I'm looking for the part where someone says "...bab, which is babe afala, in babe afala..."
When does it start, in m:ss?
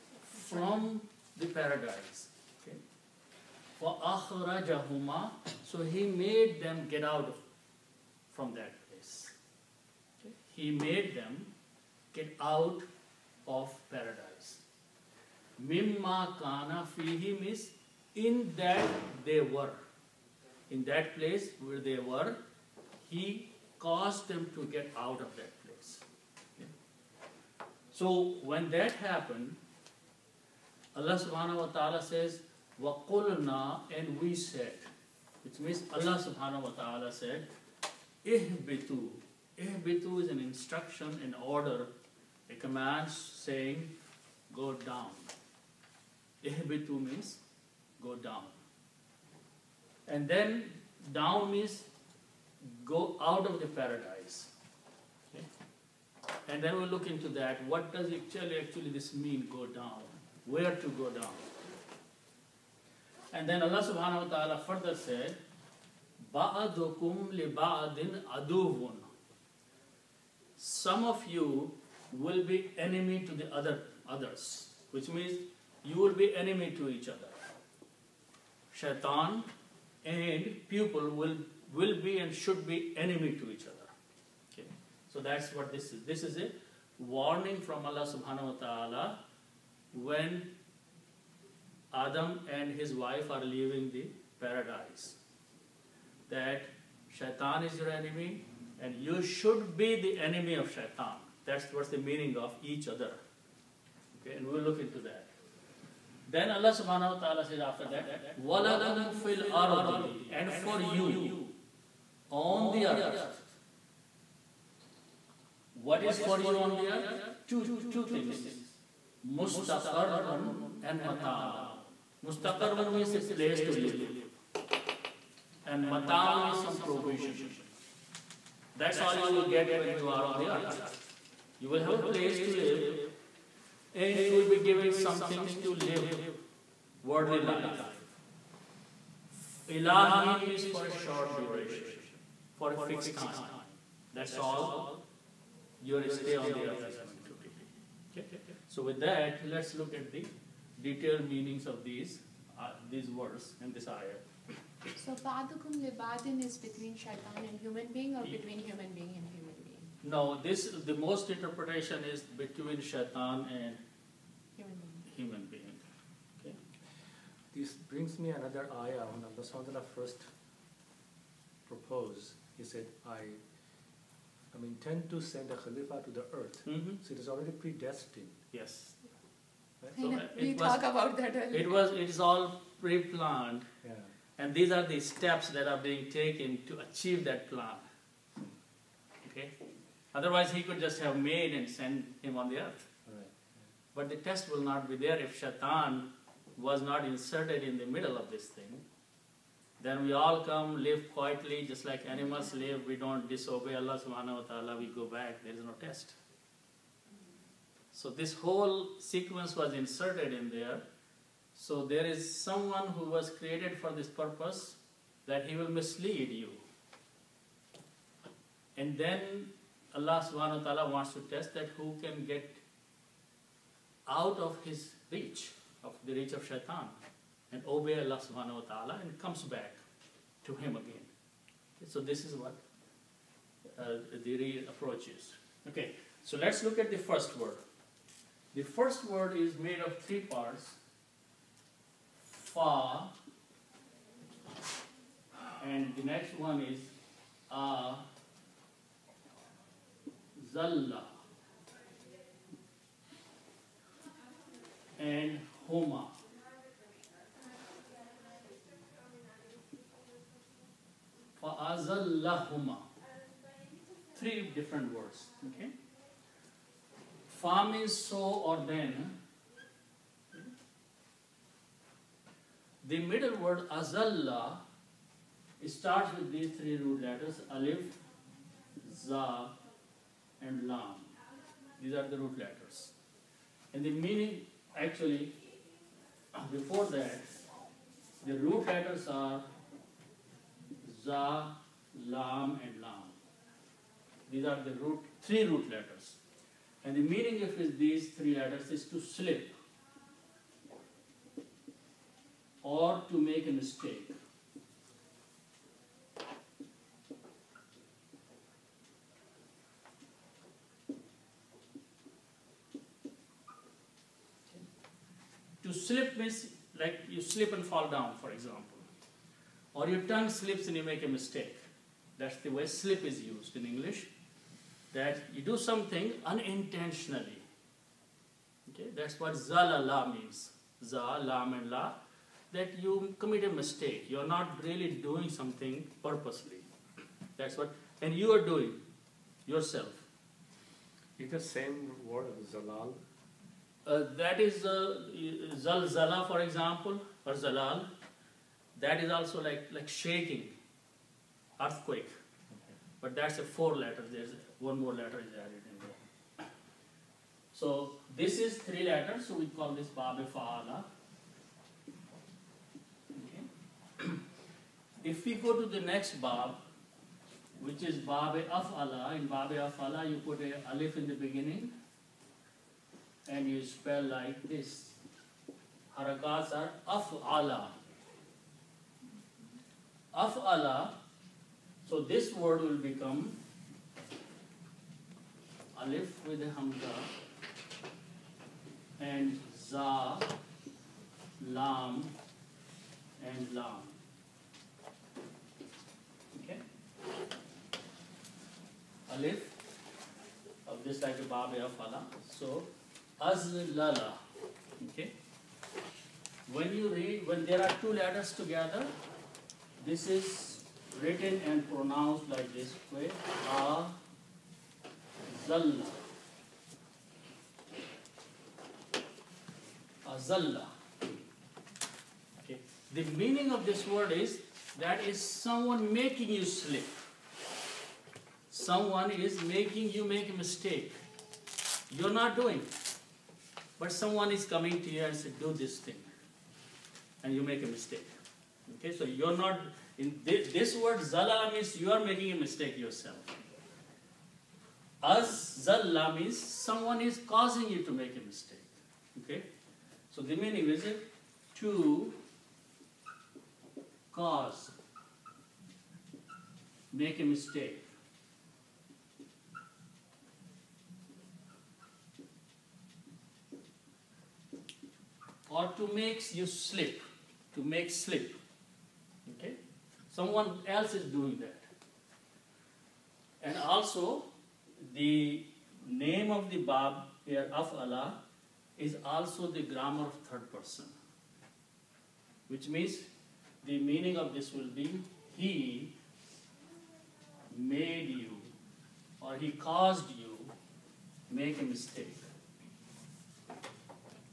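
6:06.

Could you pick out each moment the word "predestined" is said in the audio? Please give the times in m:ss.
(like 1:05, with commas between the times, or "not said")
2:57.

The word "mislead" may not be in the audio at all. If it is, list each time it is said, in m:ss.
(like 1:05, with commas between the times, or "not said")
3:35.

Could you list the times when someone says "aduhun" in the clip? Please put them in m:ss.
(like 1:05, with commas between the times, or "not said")
1:08.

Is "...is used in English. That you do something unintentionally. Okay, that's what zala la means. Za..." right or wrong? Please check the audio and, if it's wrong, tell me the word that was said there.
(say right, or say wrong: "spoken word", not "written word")
right.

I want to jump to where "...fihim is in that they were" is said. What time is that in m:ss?
0:16.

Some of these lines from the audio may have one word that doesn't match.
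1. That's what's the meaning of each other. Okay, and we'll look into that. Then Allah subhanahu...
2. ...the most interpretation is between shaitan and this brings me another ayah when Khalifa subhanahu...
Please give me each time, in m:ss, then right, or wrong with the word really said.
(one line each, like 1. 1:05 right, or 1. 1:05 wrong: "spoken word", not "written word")
1. 1:41 right
2. 2:40 wrong: "Allah", not "Khalifa".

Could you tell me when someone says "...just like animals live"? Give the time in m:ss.
3:21.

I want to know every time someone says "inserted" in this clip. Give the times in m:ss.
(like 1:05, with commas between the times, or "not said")
3:17, 3:29.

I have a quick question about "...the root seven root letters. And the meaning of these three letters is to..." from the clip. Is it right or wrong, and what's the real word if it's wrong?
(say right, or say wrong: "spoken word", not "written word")
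wrong: "three", not "seven".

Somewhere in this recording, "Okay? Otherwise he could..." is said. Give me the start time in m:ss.
3:09.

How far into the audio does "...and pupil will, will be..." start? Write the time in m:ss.
1:20.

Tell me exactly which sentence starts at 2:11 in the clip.
You will have a place to live and you will be given some things to live worldly life.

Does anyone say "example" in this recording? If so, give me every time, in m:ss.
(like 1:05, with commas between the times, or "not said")
5:18, 5:46.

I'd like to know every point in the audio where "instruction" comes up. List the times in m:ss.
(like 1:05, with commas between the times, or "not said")
0:40.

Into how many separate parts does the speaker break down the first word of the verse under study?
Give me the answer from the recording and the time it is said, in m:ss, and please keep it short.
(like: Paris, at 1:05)
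3, at 3:59.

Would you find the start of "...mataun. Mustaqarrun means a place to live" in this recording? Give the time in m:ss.
2:01.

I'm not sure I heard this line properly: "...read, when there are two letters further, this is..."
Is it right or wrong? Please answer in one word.
wrong.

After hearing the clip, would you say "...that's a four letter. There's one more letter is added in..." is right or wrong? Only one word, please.
right.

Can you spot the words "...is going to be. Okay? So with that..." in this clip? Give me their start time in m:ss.
2:26.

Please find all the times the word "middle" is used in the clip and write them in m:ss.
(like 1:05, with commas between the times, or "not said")
3:17, 4:33.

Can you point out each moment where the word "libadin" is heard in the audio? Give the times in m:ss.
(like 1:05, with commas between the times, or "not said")
2:35.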